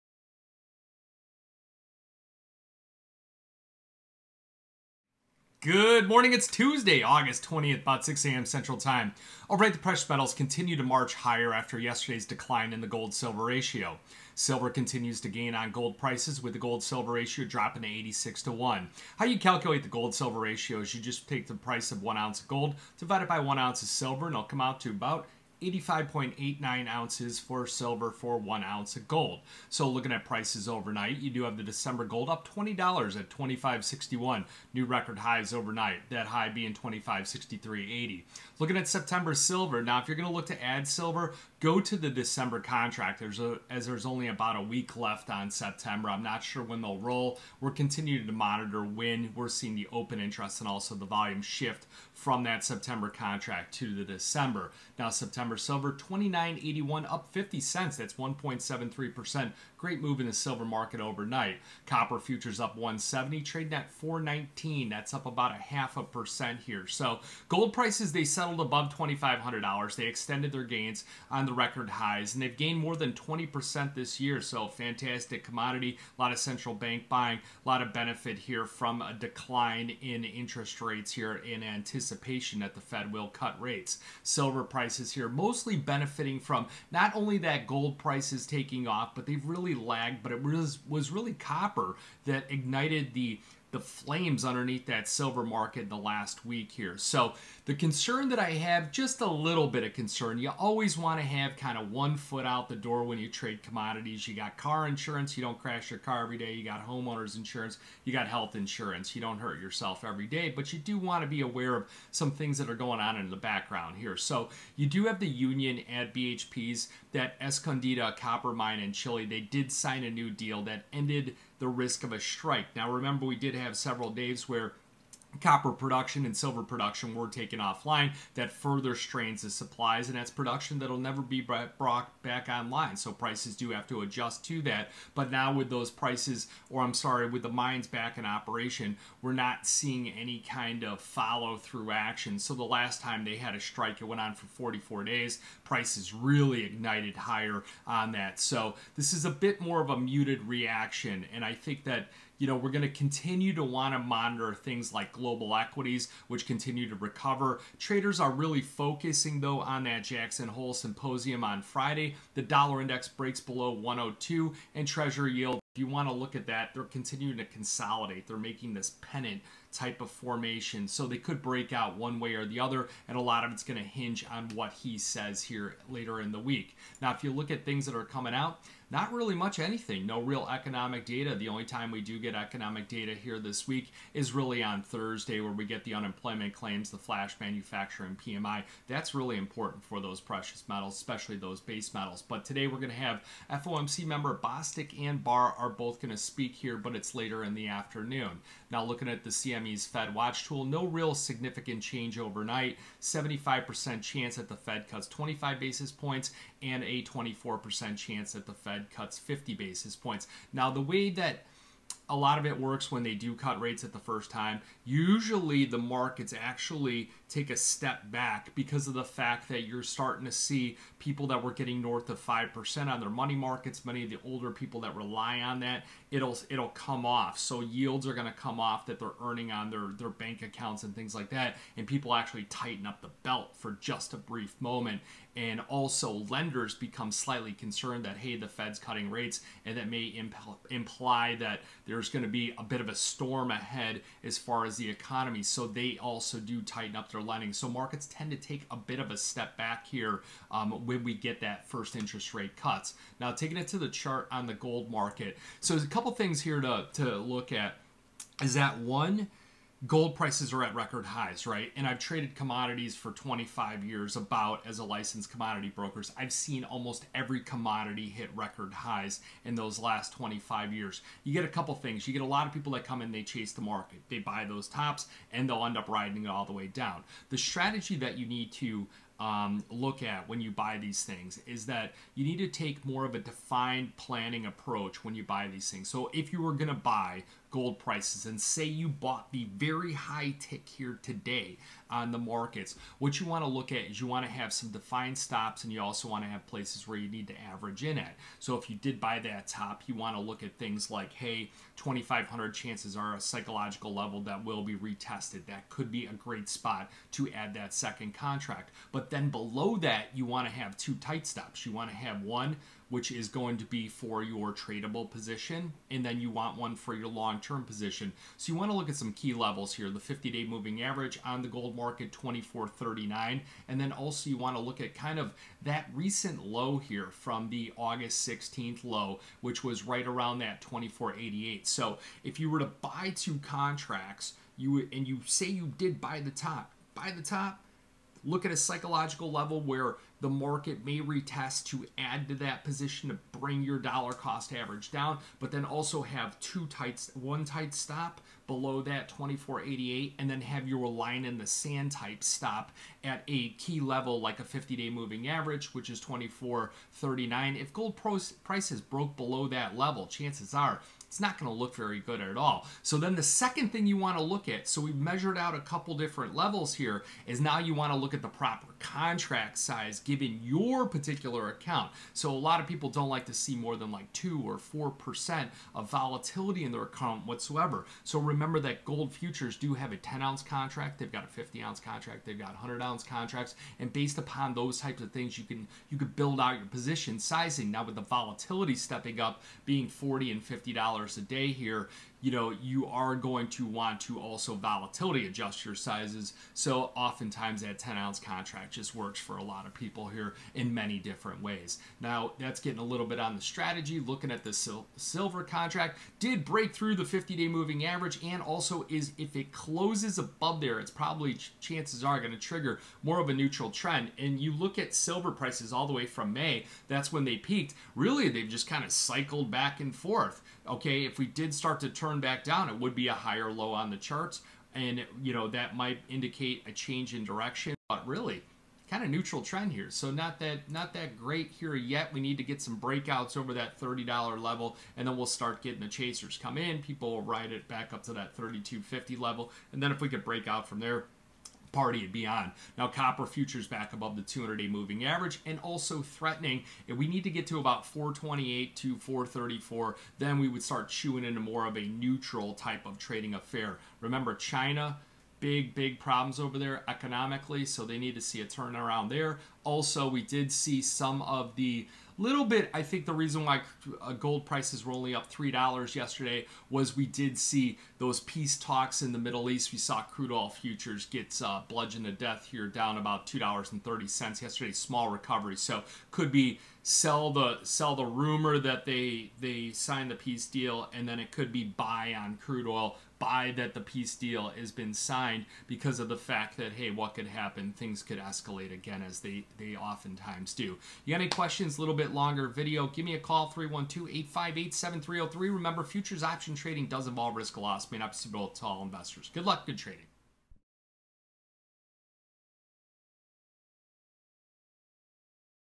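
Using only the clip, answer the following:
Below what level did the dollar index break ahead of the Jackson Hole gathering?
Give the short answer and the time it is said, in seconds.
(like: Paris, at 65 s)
102, at 163 s.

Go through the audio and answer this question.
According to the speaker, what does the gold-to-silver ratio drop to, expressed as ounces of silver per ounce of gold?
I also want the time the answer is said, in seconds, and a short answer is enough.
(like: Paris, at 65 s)
86 to 1, at 17 s.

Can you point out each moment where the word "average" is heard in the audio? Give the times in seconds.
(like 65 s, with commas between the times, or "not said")
297 s, 320 s, 344 s, 355 s, 407 s, 445 s.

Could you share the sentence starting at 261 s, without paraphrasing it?
And I've traded commodities for 25 years about as a licensed commodity broker.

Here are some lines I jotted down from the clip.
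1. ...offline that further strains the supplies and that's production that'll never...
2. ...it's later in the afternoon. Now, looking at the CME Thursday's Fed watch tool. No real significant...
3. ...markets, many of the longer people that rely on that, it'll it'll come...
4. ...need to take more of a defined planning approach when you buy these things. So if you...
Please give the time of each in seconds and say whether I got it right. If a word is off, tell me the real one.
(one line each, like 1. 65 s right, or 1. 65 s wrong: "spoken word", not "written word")
1. 127 s right
2. 196 s wrong: "Miami", not "Thursday"
3. 223 s wrong: "older", not "longer"
4. 282 s right.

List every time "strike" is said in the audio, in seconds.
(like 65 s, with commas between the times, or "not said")
122 s, 143 s.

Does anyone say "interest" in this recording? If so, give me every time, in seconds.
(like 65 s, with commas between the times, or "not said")
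50 s, 80 s, 251 s.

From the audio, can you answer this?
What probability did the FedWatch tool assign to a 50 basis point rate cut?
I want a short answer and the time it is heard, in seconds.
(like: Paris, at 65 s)
24%, at 207 s.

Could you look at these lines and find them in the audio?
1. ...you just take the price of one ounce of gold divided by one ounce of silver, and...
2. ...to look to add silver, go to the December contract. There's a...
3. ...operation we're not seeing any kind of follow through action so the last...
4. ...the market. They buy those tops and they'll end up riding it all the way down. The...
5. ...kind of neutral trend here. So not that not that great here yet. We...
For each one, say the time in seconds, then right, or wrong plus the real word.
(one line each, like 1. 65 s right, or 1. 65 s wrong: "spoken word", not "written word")
1. 20 s right
2. 40 s right
3. 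138 s right
4. 273 s right
5. 428 s right.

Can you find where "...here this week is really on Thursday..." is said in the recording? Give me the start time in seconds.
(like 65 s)
183 s.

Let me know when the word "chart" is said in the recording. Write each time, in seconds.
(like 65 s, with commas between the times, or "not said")
253 s, 423 s.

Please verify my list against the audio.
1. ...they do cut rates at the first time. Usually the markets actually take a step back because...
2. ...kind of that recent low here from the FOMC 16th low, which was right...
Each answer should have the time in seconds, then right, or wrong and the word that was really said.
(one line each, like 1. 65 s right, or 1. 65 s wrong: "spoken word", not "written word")
1. 213 s right
2. 324 s wrong: "August", not "FOMC".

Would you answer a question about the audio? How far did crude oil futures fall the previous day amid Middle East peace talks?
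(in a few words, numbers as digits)
$2.30.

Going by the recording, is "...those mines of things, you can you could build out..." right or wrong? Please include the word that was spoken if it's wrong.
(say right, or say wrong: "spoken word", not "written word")
wrong: "types", not "mines".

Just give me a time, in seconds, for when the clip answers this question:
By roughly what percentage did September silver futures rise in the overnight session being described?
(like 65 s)
58 s.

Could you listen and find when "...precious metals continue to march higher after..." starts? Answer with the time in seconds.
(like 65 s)
9 s.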